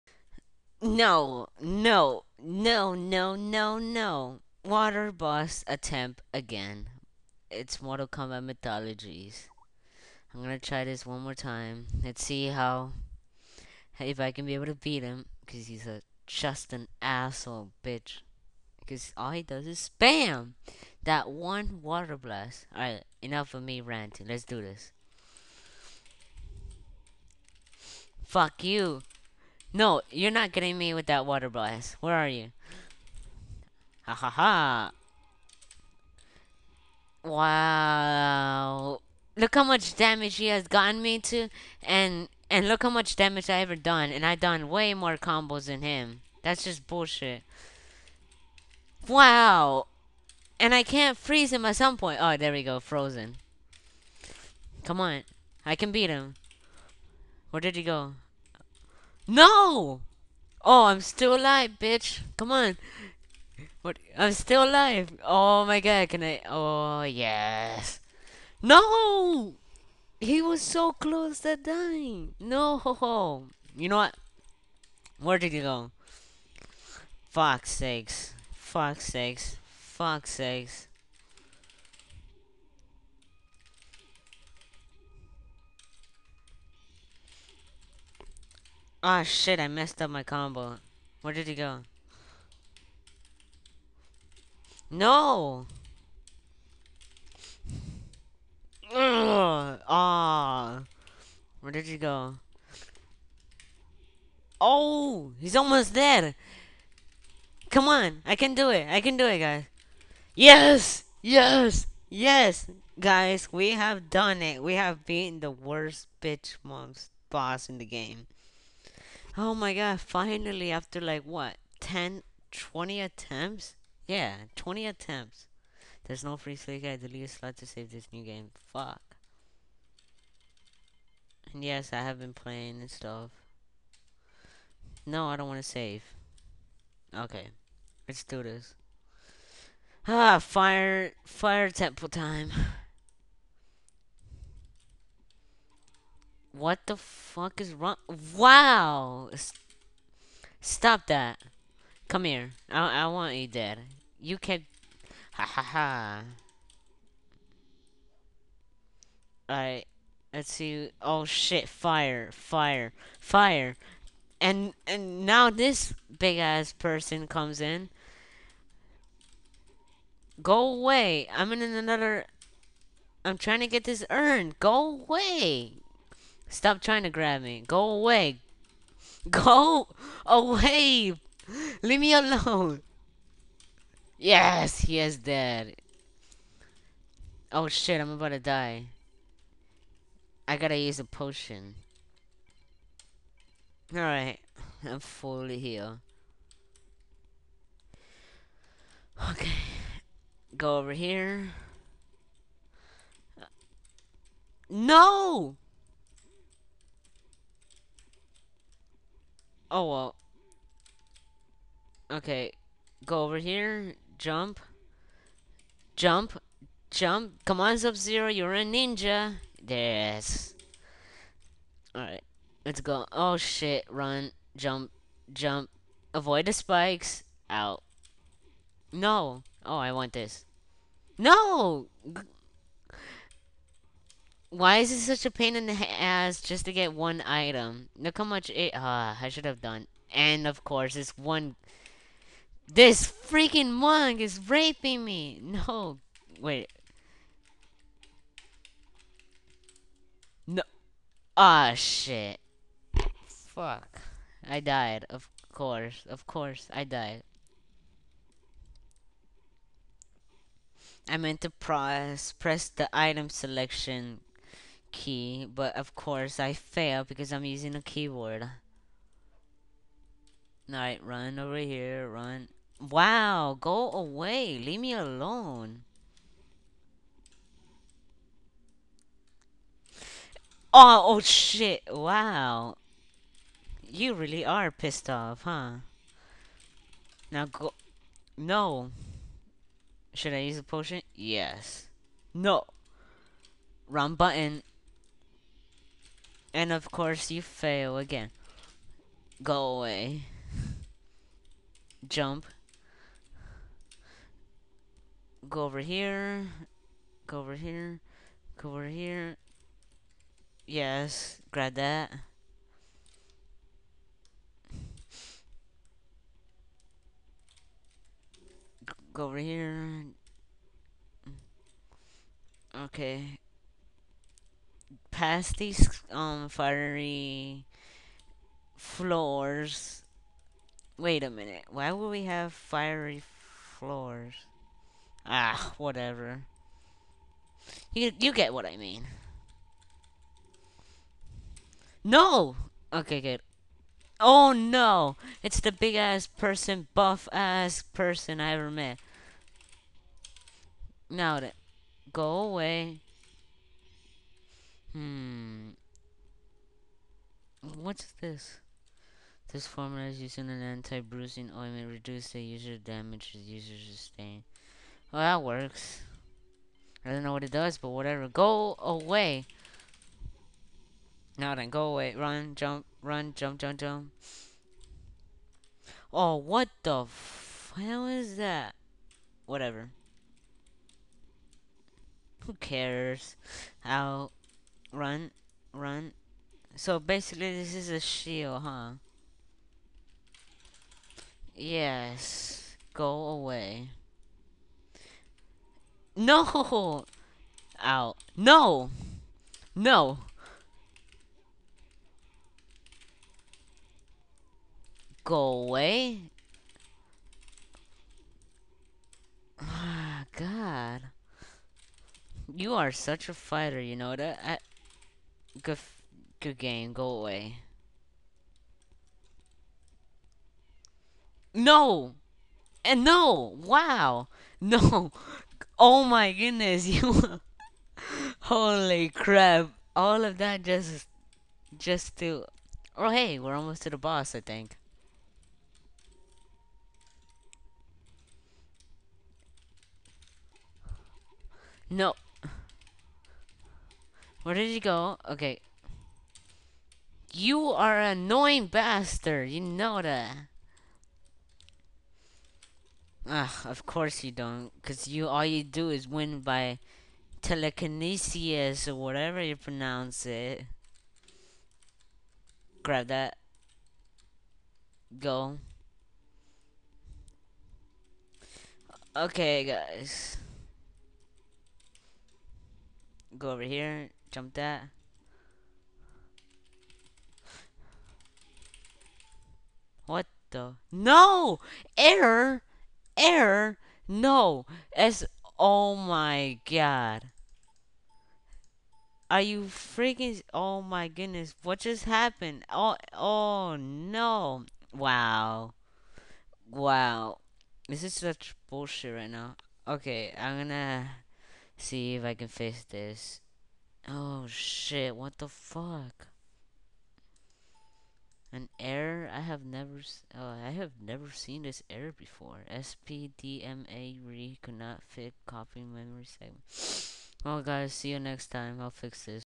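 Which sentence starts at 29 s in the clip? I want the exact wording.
No, you're not getting me with that water blast.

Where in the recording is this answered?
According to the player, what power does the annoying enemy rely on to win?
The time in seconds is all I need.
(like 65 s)
457 s.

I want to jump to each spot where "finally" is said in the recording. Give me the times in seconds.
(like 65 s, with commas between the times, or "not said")
120 s.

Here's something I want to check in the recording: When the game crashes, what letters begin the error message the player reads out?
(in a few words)
SPDMA.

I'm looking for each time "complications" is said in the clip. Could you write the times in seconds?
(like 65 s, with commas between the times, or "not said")
not said.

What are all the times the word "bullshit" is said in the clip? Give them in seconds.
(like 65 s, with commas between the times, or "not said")
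46 s, 498 s.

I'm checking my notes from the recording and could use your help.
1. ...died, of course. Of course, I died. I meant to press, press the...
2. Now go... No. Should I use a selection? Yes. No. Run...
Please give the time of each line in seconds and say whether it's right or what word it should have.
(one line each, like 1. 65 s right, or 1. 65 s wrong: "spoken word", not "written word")
1. 254 s right
2. 287 s wrong: "potion", not "selection".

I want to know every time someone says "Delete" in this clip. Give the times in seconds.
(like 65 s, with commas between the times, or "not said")
126 s.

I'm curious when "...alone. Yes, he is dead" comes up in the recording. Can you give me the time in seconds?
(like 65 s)
182 s.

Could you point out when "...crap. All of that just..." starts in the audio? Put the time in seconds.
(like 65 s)
429 s.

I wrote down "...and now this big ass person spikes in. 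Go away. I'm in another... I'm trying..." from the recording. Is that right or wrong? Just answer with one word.
wrong.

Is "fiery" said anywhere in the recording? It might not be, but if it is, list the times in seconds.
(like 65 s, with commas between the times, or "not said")
326 s, 332 s.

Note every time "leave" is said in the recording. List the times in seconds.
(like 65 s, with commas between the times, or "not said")
181 s, 274 s.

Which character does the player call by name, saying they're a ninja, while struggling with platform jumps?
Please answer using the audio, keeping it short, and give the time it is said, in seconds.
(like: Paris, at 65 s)
Sub-Zero, at 217 s.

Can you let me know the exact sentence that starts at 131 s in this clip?
And yes, I have been playing and stuff.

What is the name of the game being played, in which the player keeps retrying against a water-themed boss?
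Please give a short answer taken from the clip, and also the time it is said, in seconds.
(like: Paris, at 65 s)
Mortal Kombat Mythologies, at 7 s.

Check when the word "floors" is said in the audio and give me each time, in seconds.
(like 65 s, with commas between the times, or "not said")
328 s, 333 s.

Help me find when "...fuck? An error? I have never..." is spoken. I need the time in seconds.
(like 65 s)
505 s.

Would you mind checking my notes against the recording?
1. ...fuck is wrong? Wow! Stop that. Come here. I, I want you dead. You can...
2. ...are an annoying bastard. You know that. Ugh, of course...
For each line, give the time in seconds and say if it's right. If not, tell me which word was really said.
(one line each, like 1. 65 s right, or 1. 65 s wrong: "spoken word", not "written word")
1. 146 s right
2. 447 s right.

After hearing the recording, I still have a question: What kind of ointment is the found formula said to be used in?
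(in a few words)
Anti-bruising.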